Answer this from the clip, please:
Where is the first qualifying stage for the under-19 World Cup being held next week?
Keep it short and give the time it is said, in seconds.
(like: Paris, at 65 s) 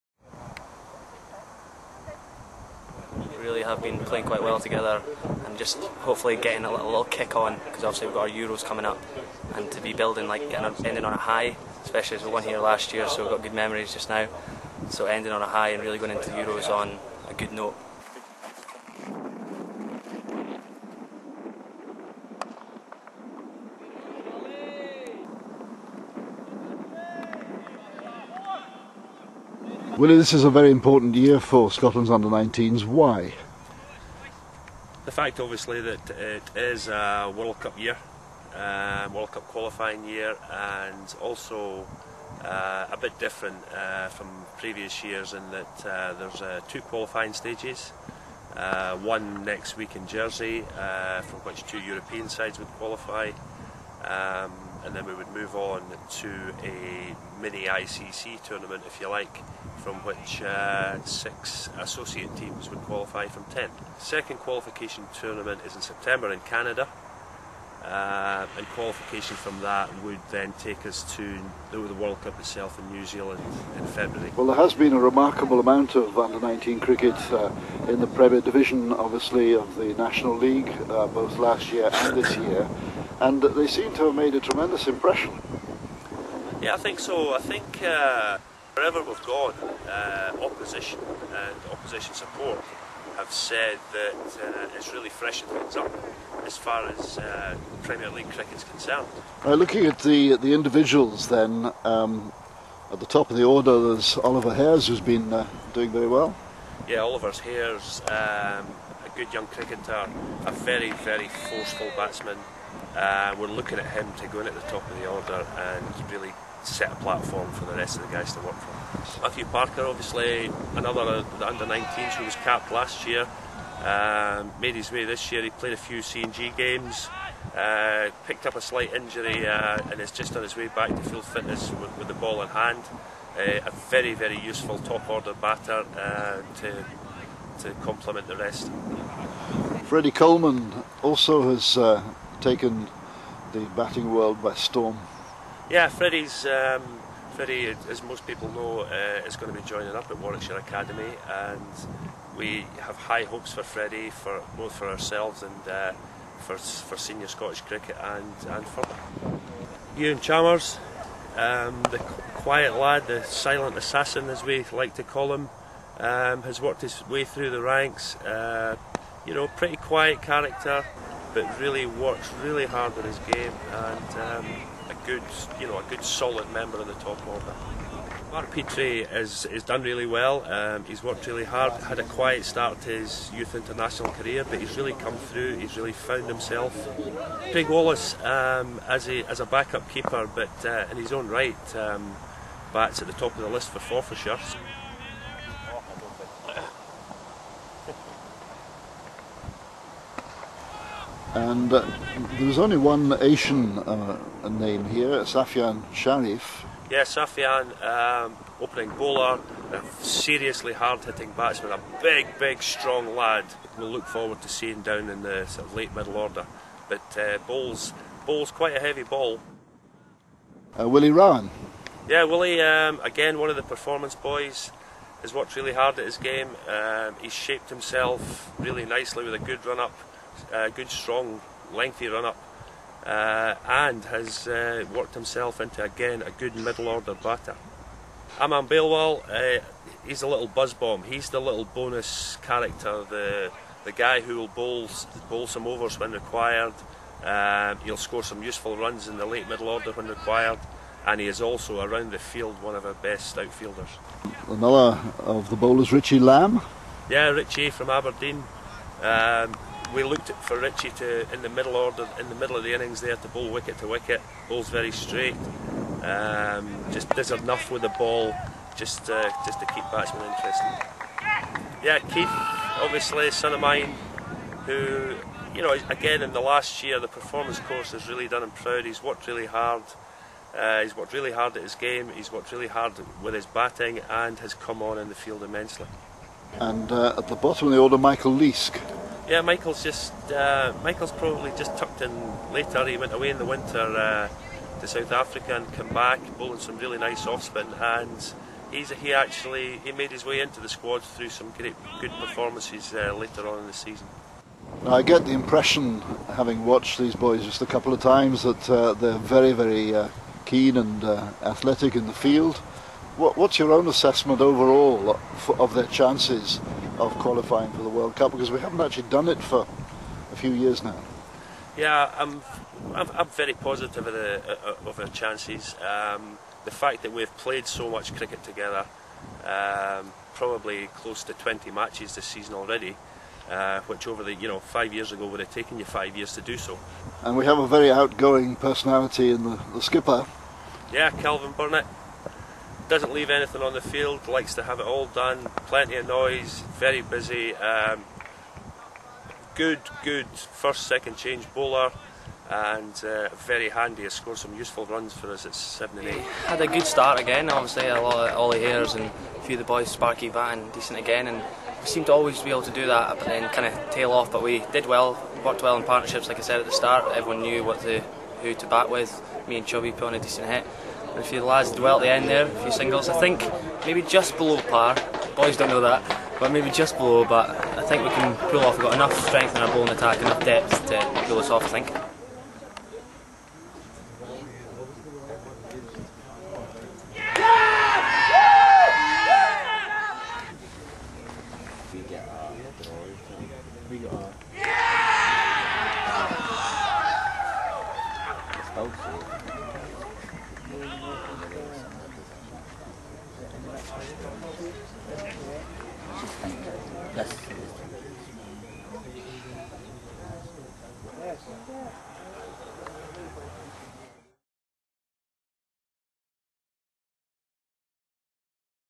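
Jersey, at 50 s.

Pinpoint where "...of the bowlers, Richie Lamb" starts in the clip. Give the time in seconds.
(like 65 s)
255 s.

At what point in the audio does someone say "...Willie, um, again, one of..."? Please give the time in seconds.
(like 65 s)
222 s.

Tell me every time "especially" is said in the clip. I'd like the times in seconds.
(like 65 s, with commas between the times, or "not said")
11 s.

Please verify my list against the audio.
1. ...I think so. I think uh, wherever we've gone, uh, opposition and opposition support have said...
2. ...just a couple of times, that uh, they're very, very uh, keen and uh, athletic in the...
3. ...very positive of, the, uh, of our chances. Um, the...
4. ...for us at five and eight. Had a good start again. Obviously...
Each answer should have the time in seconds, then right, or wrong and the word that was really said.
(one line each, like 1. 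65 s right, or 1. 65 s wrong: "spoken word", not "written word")
1. 86 s right
2. 307 s right
3. 323 s right
4. 355 s wrong: "seven", not "five".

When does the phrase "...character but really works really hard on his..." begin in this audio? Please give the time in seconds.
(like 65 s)
170 s.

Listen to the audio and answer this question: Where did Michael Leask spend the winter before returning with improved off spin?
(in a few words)
South Africa.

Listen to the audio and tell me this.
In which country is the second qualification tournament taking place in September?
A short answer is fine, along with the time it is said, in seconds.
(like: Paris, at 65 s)
Canada, at 66 s.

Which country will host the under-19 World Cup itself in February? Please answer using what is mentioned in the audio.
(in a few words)
New Zealand.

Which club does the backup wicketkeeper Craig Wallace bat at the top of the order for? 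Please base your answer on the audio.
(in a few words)
Forfarshire.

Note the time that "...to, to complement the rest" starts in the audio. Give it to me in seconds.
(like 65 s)
136 s.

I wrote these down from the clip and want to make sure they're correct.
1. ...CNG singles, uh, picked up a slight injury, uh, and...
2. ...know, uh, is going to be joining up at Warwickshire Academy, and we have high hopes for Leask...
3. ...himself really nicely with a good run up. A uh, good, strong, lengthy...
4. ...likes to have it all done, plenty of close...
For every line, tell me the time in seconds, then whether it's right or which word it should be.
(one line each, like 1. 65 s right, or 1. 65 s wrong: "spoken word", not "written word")
1. 125 s wrong: "games", not "singles"
2. 148 s wrong: "Freddie", not "Leask"
3. 227 s right
4. 344 s wrong: "noise", not "close".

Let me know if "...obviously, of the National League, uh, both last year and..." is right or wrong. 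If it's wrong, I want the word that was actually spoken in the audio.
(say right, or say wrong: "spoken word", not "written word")
right.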